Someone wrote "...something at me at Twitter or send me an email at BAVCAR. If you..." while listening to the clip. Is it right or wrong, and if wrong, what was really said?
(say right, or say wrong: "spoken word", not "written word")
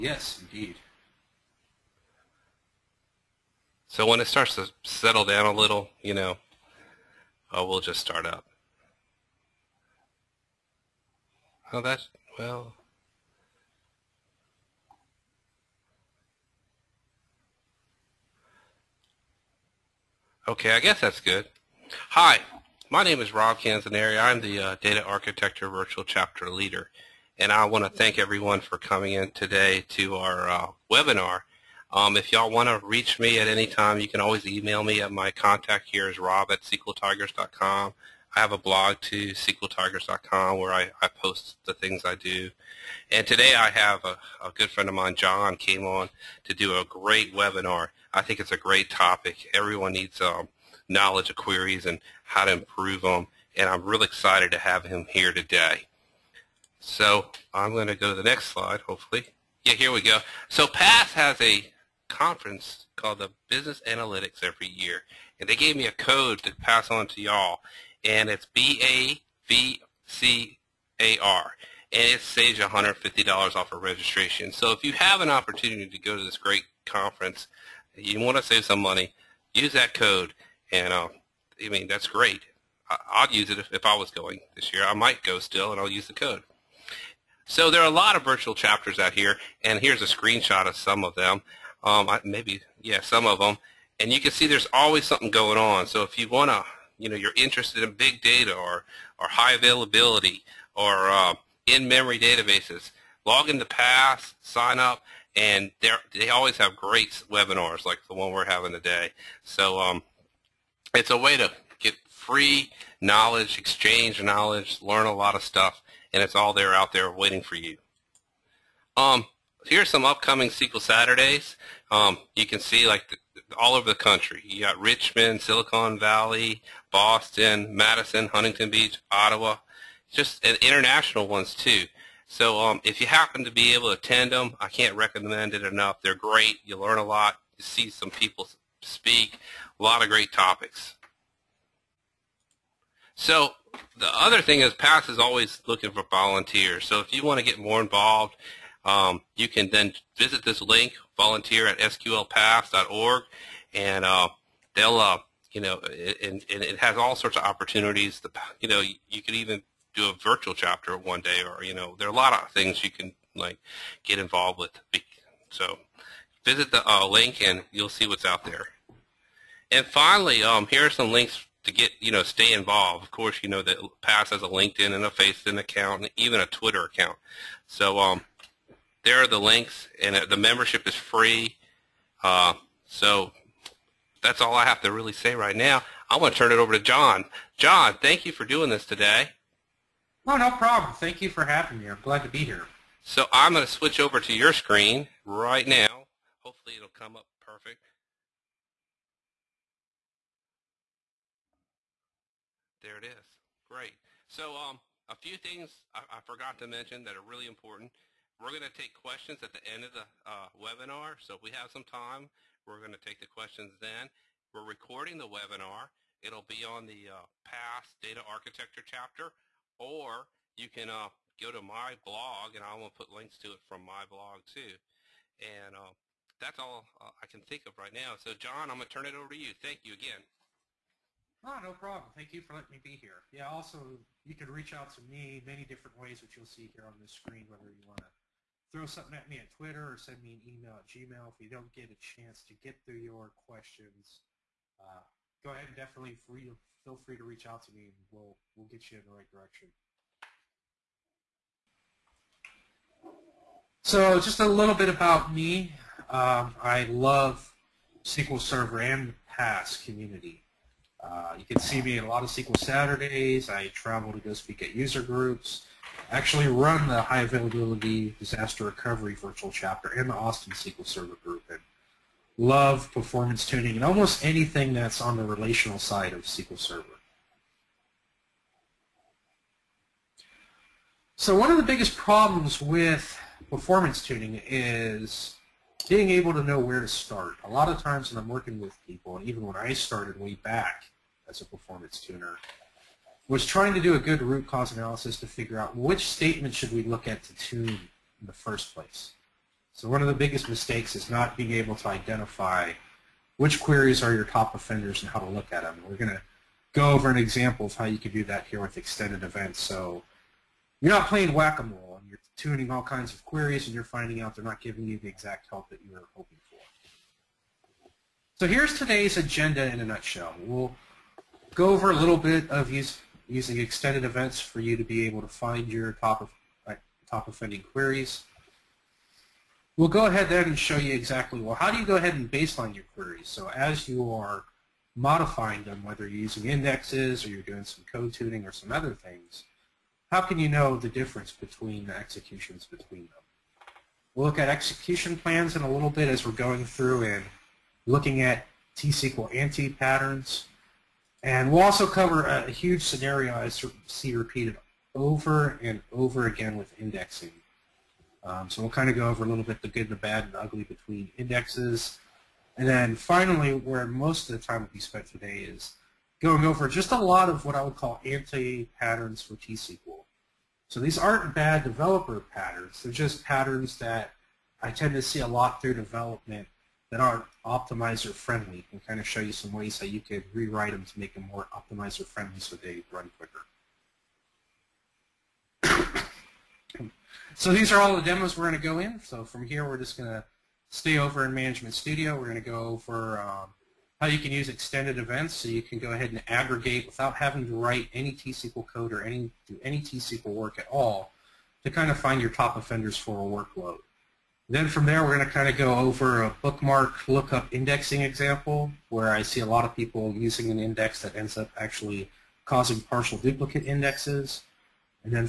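wrong: "Gmail", not "BAVCAR".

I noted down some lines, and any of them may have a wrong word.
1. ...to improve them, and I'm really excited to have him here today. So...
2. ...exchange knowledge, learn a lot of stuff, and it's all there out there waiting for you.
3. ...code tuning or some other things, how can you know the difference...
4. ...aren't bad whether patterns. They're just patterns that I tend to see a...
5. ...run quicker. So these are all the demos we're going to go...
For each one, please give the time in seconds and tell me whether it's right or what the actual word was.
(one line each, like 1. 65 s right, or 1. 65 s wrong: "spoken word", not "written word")
1. 52 s right
2. 113 s right
3. 337 s right
4. 370 s wrong: "developer", not "whether"
5. 382 s right.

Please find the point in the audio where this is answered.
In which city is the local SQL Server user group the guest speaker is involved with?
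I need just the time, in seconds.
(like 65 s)
270 s.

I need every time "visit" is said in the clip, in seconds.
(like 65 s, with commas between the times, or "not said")
150 s, 166 s.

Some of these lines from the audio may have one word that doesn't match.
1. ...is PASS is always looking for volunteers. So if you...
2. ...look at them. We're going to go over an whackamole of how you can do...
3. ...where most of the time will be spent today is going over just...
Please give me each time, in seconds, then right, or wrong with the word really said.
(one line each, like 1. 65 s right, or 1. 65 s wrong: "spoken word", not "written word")
1. 144 s right
2. 305 s wrong: "example", not "whackamole"
3. 363 s right.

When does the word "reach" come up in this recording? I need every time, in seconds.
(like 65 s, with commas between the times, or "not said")
32 s, 234 s, 247 s.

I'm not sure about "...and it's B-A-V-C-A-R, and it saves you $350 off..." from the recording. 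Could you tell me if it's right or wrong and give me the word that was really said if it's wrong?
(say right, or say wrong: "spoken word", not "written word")
wrong: "150", not "350".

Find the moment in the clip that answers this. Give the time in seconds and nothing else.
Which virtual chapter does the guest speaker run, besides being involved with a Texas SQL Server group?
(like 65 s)
267 s.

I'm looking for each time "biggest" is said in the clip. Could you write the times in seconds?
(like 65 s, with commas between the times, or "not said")
281 s, 300 s.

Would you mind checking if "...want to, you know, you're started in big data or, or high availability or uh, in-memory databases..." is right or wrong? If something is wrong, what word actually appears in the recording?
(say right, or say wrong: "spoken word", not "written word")
wrong: "interested", not "started".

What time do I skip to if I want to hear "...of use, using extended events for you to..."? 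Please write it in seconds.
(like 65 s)
322 s.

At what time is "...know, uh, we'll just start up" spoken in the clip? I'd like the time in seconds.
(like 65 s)
6 s.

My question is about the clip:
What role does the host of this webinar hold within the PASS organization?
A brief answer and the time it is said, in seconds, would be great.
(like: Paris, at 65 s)
Data Architecture Virtual Chapter Leader, at 24 s.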